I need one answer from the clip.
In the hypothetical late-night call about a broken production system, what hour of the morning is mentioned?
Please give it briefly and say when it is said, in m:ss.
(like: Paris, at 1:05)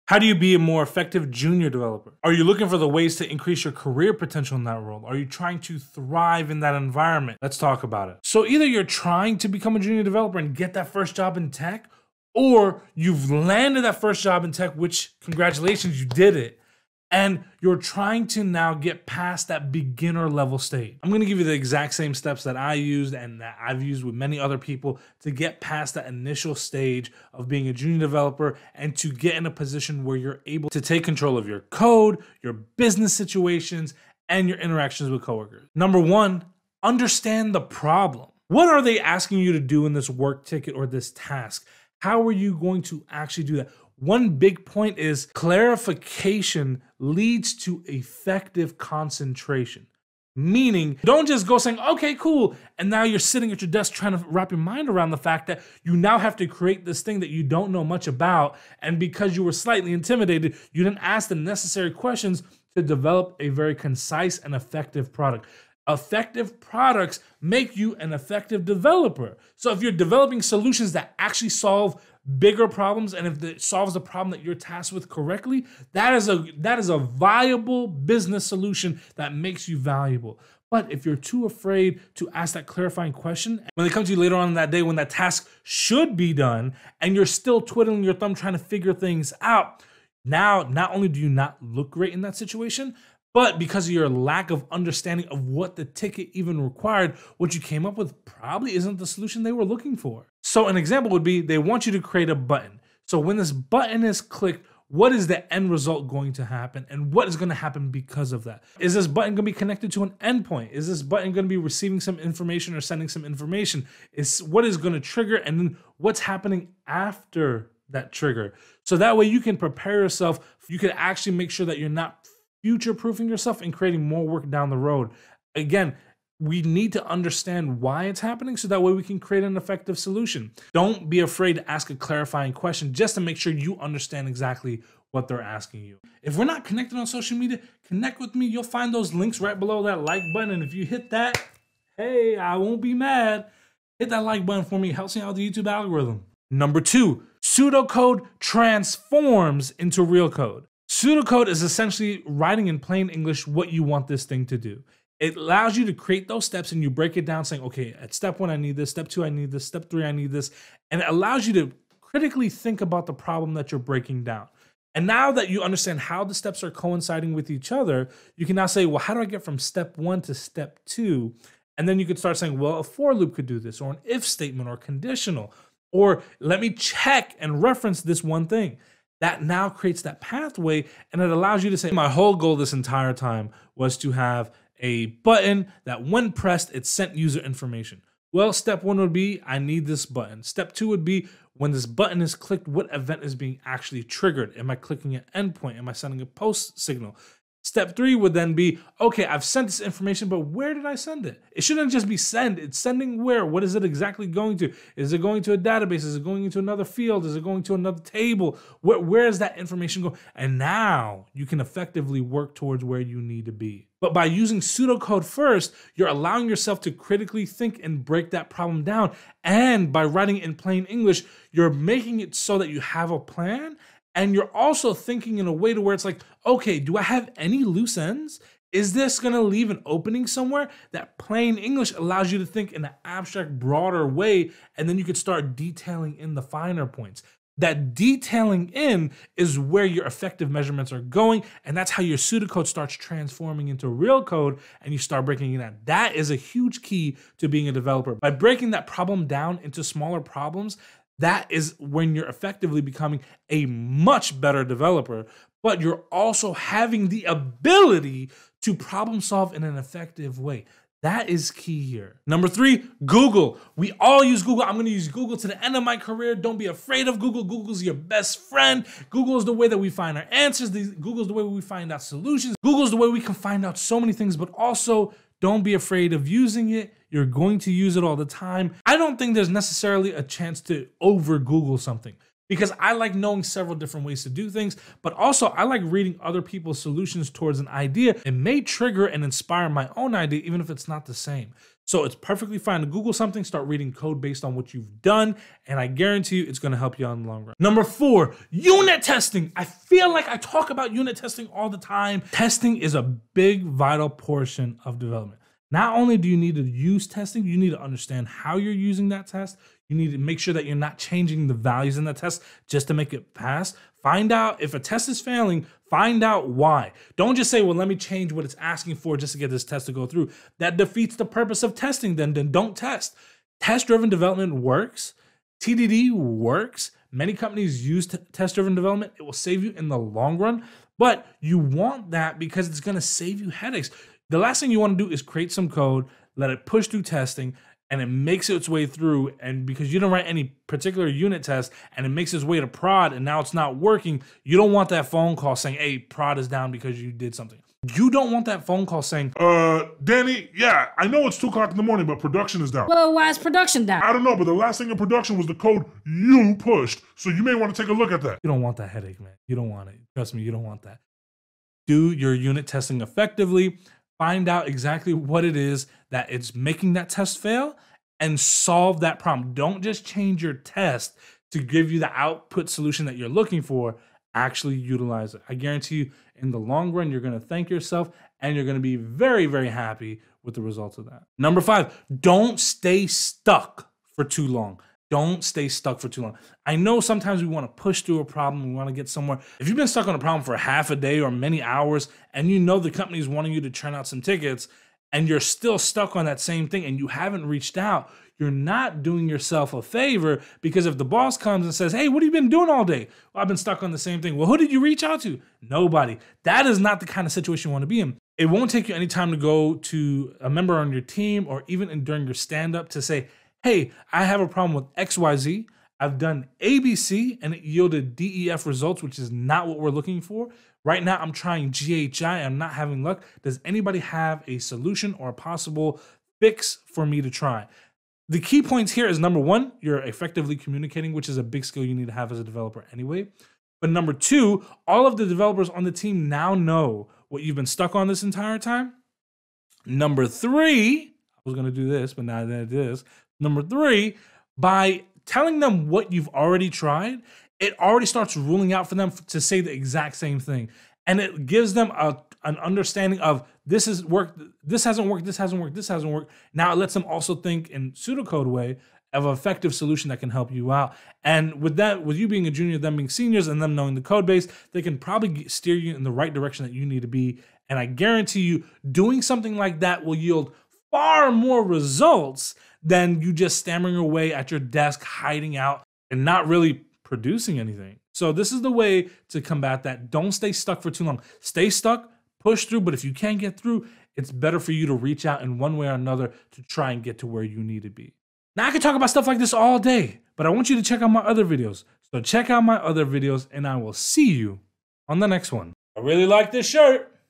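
2 o'clock, at 5:51.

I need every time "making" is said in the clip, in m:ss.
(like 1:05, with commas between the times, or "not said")
3:41, 6:06.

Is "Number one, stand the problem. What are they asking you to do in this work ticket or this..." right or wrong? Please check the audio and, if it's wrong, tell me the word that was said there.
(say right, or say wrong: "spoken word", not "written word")
wrong: "understand", not "stand".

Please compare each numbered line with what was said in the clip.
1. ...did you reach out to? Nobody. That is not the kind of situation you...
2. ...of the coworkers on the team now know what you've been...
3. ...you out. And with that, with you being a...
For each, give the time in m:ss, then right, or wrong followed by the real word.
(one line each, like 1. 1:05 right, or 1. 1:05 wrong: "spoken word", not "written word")
1. 6:44 right
2. 7:15 wrong: "developers", not "coworkers"
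3. 7:40 right.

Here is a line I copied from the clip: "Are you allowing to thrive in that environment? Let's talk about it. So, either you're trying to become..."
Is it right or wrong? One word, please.
wrong.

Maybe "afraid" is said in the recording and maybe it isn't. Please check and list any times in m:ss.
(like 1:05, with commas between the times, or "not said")
1:21, 2:11, 4:26, 4:35.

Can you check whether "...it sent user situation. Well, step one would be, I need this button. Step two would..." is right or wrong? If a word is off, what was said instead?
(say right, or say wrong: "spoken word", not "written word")
wrong: "information", not "situation".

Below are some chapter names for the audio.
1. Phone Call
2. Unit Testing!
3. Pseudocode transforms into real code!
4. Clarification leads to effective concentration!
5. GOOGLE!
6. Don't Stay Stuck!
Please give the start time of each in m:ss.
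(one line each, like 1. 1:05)
1. 5:47
2. 4:57
3. 2:16
4. 0:35
5. 4:21
6. 6:20.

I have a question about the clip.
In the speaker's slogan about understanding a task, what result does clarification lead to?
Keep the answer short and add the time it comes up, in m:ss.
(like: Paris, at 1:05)
Effective concentration, at 0:47.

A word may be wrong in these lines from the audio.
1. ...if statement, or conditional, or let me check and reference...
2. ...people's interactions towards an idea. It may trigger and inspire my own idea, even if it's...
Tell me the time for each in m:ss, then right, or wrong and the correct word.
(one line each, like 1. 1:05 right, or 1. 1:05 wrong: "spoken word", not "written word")
1. 2:54 right
2. 4:46 wrong: "solutions", not "interactions".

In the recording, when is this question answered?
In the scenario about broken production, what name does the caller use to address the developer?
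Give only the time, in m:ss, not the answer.
5:50.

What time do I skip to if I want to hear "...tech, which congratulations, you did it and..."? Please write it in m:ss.
0:14.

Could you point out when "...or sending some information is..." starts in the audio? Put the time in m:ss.
1:52.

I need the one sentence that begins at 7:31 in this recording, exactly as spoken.
And it gives them a, an understanding of this has worked, this hasn't worked, this hasn't worked, this hasn't worked.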